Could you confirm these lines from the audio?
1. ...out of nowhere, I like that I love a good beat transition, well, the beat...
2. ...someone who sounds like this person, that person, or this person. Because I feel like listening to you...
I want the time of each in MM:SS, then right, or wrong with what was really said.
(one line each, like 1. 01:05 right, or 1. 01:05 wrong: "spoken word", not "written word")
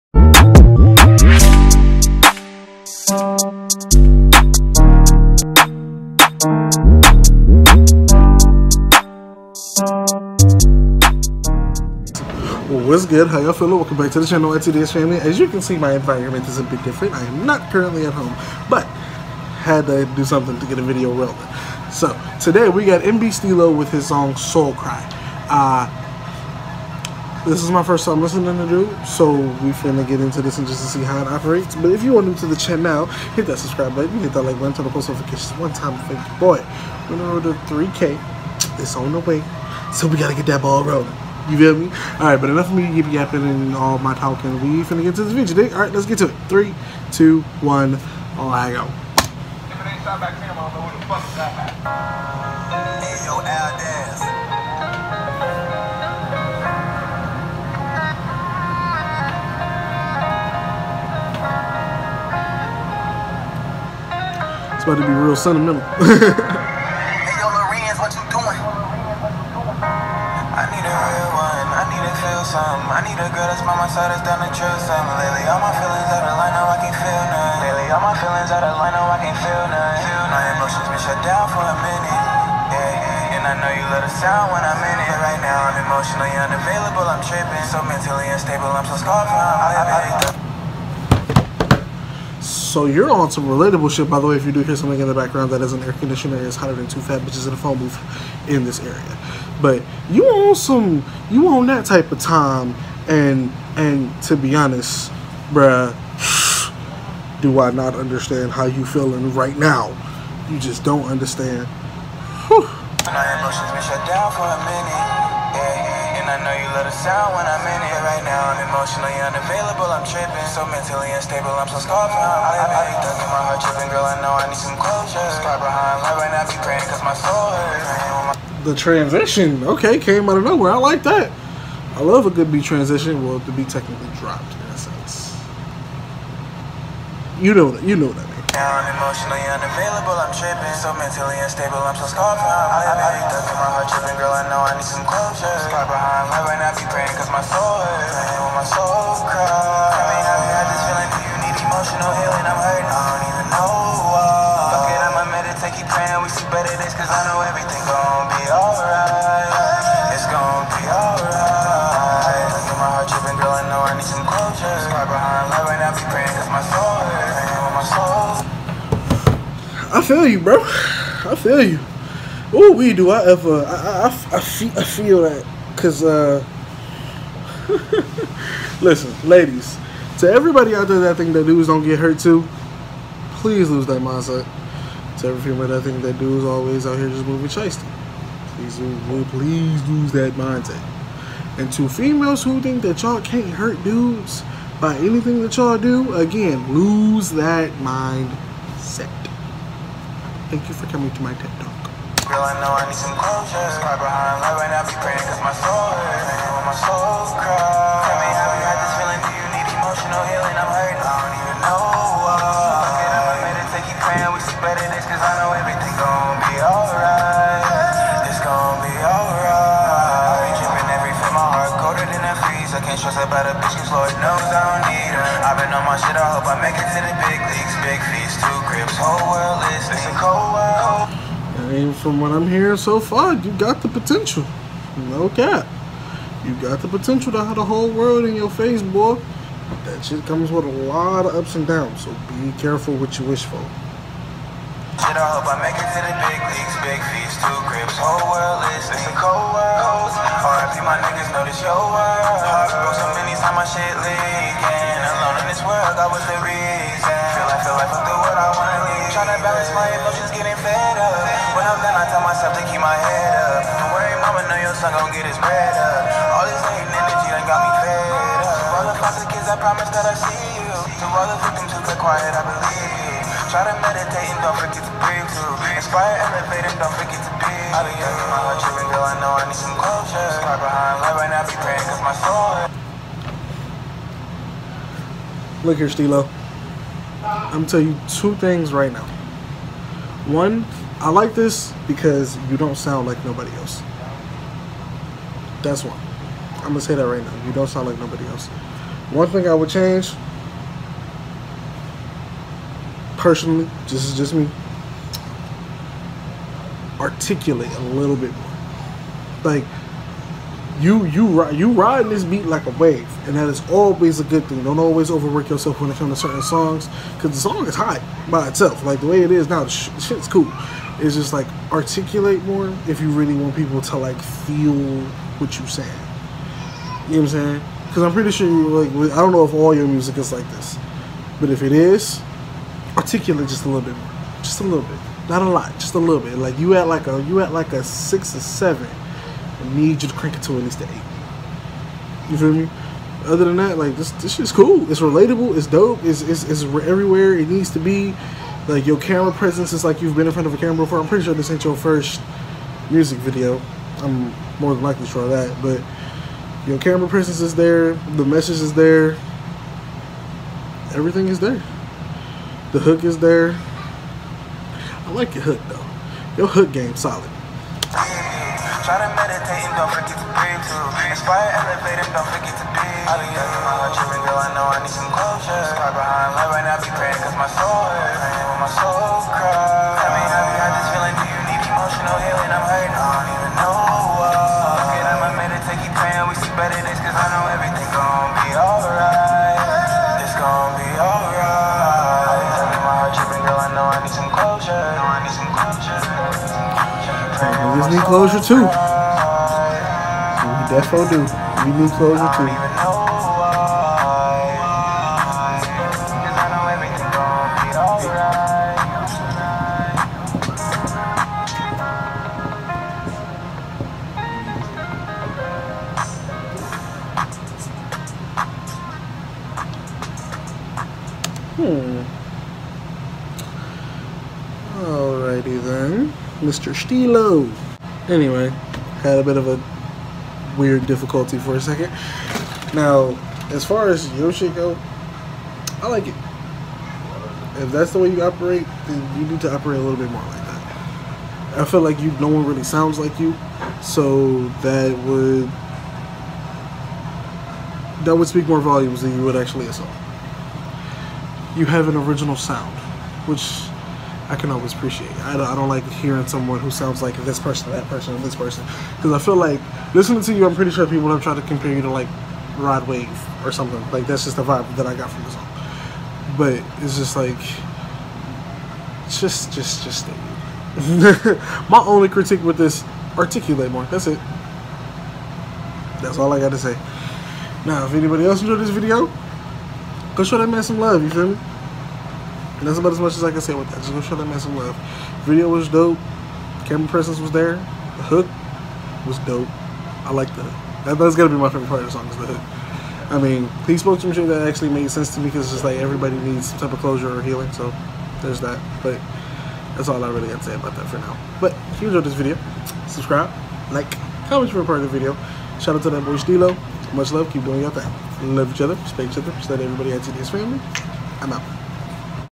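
1. 02:10 right
2. 07:36 right.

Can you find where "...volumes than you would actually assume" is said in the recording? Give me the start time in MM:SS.
07:28.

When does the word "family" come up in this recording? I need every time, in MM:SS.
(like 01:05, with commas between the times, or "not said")
00:14, 08:30.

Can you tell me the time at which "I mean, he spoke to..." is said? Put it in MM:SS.
08:13.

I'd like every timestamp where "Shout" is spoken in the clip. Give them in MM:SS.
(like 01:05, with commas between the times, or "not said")
08:25.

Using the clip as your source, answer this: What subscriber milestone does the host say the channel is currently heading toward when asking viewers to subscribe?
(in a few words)
3K.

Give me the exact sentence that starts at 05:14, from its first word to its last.
Don't always overwork yourself when it comes to certain songs, because the song is hot by itself.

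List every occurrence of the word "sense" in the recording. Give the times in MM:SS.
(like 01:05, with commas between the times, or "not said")
02:14, 08:14.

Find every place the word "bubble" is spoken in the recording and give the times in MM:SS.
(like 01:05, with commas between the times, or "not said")
not said.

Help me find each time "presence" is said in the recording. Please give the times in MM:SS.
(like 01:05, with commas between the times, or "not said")
05:49, 05:57, 08:06.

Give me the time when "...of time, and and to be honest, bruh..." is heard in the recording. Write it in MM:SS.
01:42.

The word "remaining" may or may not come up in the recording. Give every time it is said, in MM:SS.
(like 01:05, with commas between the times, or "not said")
not said.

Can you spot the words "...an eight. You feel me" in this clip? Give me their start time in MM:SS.
05:40.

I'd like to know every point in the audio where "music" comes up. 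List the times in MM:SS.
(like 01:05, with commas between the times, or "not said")
05:29, 05:52.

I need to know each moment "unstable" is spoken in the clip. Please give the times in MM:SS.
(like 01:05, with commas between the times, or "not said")
01:28, 02:01, 02:21.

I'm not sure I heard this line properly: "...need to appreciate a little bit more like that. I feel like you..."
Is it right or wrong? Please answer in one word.
wrong.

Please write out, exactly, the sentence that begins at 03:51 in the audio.
And from what I'm hearing so far, you got the potential.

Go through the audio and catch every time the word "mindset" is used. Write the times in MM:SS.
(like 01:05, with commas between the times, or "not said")
03:04, 03:10, 03:17.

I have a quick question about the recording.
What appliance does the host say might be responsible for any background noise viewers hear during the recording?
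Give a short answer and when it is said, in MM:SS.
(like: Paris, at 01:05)
Air conditioner, at 01:35.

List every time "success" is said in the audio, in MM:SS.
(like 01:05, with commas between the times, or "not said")
not said.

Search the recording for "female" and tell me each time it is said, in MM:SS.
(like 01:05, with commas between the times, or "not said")
03:05, 03:11.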